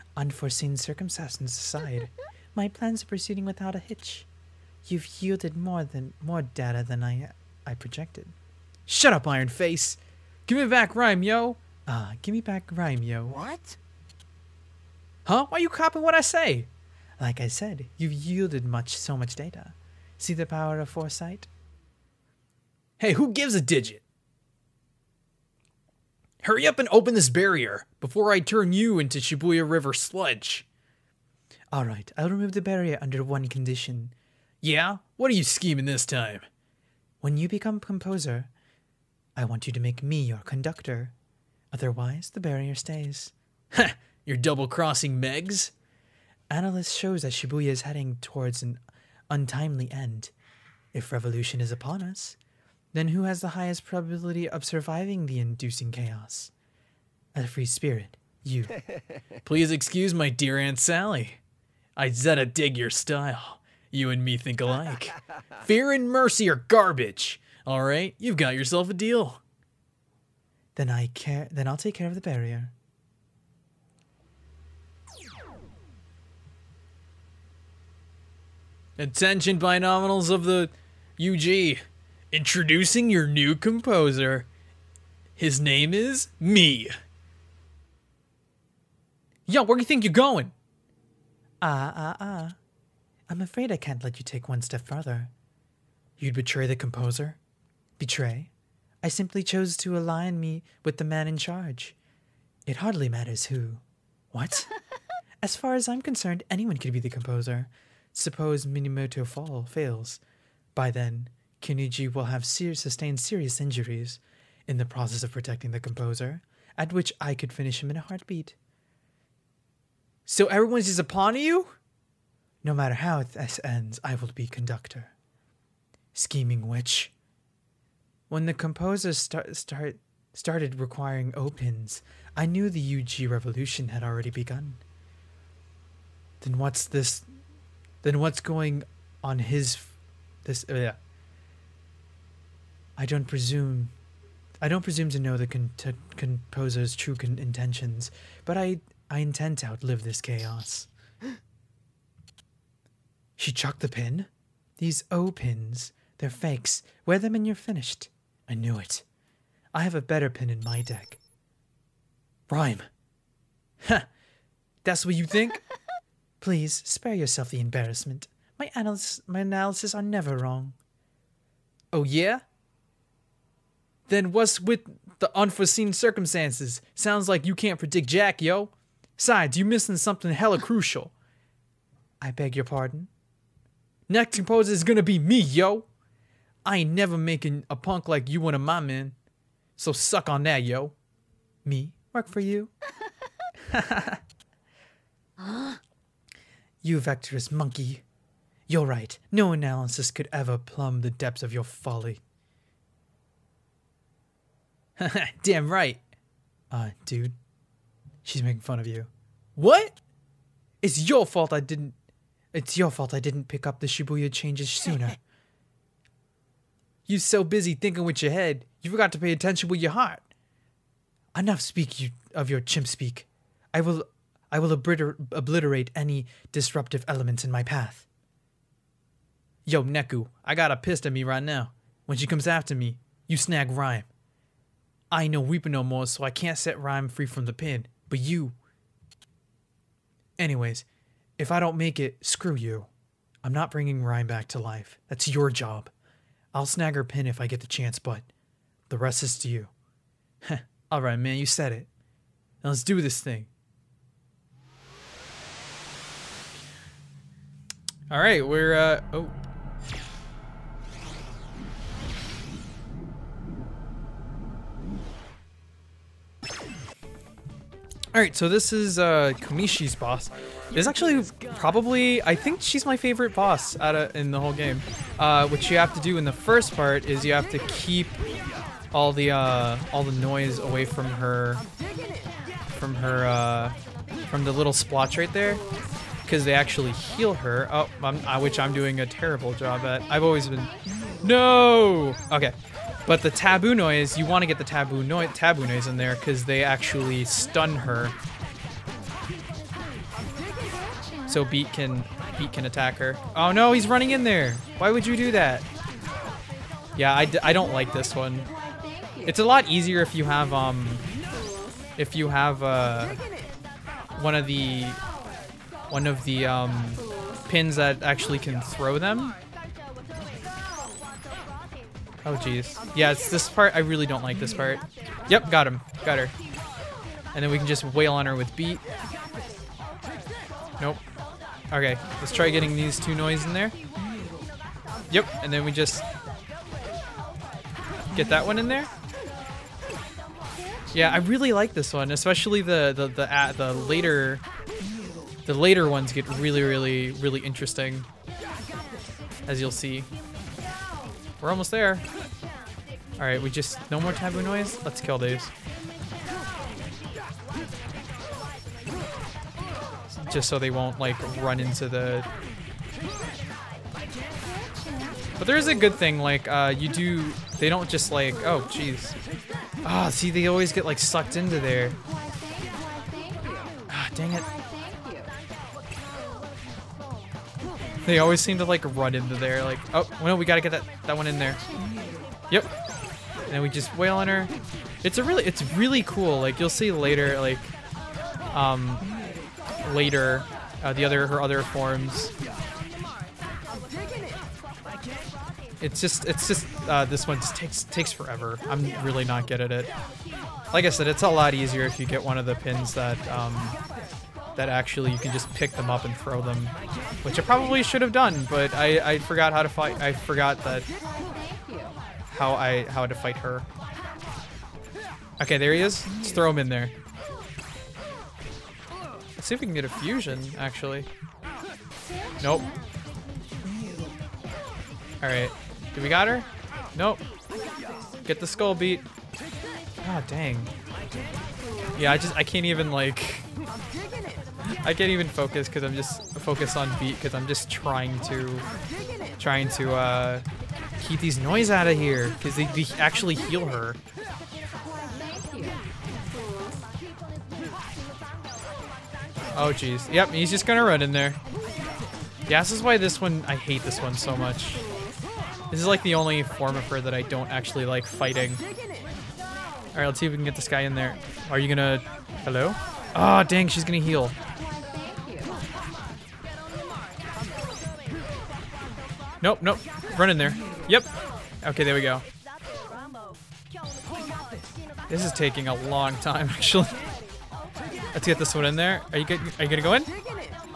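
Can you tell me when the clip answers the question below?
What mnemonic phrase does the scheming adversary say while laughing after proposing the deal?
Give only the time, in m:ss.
0:59.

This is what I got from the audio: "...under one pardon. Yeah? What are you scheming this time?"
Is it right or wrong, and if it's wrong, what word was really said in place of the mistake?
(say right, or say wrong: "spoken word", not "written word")
wrong: "condition", not "pardon".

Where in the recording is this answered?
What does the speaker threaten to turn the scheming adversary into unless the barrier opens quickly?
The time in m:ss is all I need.
0:29.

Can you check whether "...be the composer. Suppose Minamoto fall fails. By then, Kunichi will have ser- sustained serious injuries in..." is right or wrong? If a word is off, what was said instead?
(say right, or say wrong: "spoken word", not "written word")
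right.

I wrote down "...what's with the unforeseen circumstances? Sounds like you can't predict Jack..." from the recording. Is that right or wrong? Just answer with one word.
right.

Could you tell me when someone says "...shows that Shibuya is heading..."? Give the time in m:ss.
0:46.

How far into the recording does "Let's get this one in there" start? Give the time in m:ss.
7:58.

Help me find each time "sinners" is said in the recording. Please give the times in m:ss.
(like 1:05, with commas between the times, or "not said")
not said.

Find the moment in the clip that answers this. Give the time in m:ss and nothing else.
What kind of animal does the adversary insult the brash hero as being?
3:16.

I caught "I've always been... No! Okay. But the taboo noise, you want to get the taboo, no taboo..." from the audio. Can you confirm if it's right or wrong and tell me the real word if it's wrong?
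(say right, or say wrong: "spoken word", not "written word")
right.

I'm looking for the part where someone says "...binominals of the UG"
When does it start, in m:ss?
1:19.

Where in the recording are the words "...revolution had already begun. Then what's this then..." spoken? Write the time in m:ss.
2:13.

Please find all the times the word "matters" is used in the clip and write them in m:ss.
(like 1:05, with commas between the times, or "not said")
1:43, 2:02.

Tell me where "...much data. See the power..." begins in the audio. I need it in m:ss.
0:19.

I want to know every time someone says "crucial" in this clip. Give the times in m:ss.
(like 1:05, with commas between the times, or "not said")
3:00.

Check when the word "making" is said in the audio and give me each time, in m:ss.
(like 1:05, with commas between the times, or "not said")
3:07, 3:28.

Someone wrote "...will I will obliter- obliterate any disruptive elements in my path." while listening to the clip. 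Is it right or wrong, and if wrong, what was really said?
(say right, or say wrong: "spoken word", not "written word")
right.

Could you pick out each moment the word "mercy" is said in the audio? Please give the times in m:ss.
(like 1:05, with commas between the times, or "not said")
1:06.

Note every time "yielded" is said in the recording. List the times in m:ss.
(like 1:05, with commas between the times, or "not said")
0:05, 0:18.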